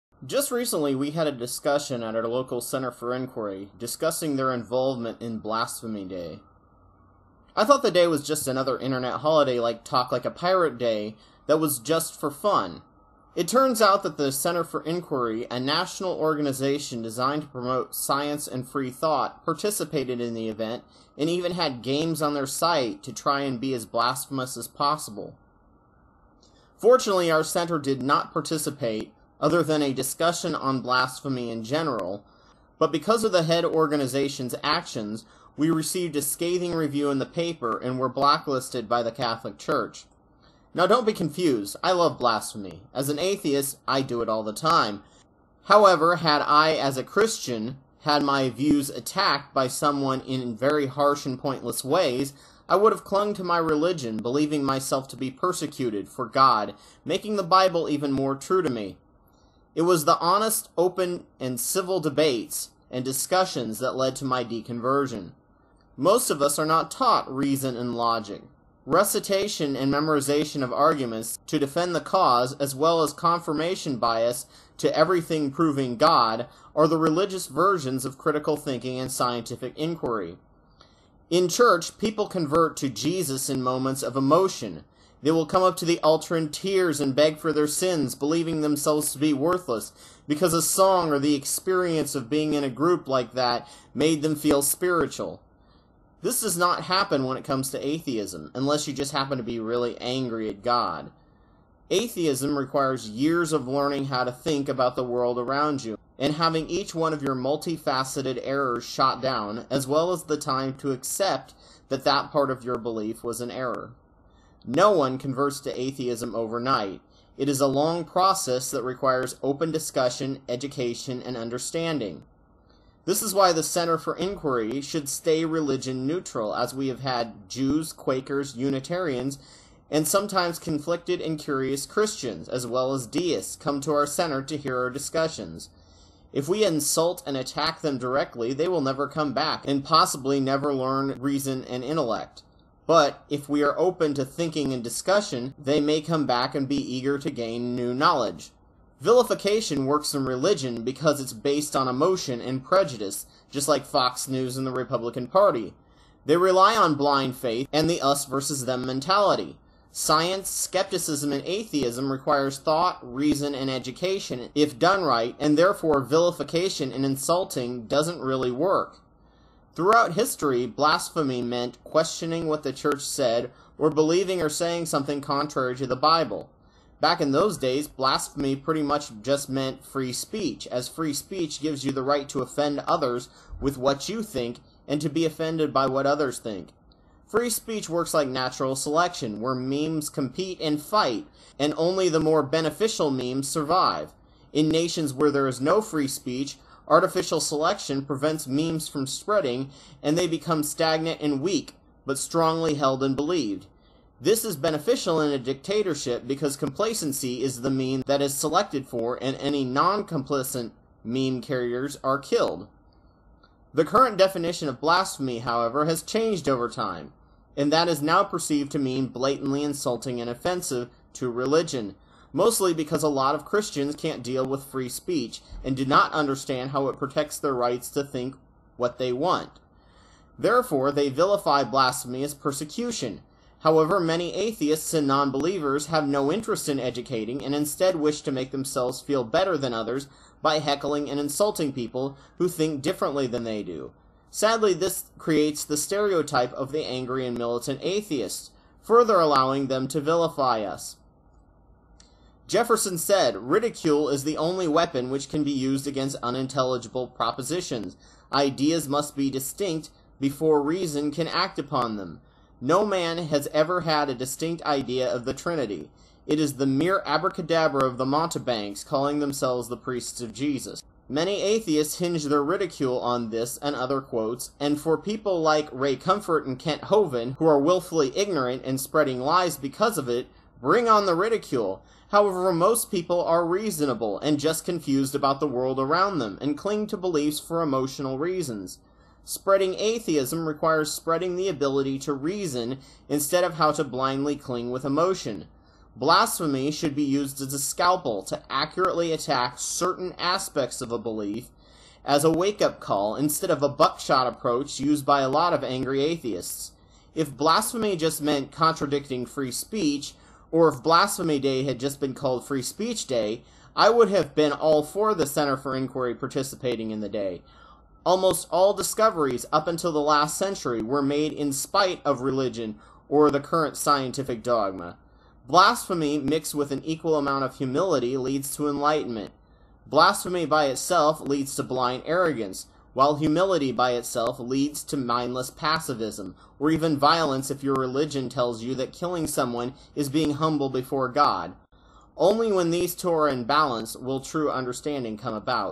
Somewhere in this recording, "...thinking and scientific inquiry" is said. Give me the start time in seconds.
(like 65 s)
78 s.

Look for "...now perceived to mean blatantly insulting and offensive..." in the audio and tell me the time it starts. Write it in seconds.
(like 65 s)
218 s.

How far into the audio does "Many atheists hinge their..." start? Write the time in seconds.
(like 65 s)
271 s.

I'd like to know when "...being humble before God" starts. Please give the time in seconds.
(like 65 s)
340 s.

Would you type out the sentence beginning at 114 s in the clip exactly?
No one converts to atheism overnight.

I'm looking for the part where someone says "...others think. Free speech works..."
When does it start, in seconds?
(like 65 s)
186 s.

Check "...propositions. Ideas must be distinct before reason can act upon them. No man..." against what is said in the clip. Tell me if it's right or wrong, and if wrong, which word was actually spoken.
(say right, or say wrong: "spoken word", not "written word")
right.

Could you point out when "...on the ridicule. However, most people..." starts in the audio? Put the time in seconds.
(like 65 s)
280 s.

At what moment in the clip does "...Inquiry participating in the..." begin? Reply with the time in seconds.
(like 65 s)
315 s.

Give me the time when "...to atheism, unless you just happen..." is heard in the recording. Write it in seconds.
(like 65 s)
97 s.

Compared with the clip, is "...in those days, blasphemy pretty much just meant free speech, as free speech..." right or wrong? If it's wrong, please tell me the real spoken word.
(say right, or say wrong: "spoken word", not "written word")
right.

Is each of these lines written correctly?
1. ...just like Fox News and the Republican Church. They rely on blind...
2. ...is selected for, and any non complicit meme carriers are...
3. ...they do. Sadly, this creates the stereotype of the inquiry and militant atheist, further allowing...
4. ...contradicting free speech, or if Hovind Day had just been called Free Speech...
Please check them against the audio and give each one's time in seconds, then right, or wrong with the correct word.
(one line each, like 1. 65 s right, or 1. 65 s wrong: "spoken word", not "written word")
1. 153 s wrong: "Party", not "Church"
2. 208 s right
3. 243 s wrong: "angry", not "inquiry"
4. 308 s wrong: "Blasphemy", not "Hovind".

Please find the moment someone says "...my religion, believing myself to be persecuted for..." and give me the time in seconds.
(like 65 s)
53 s.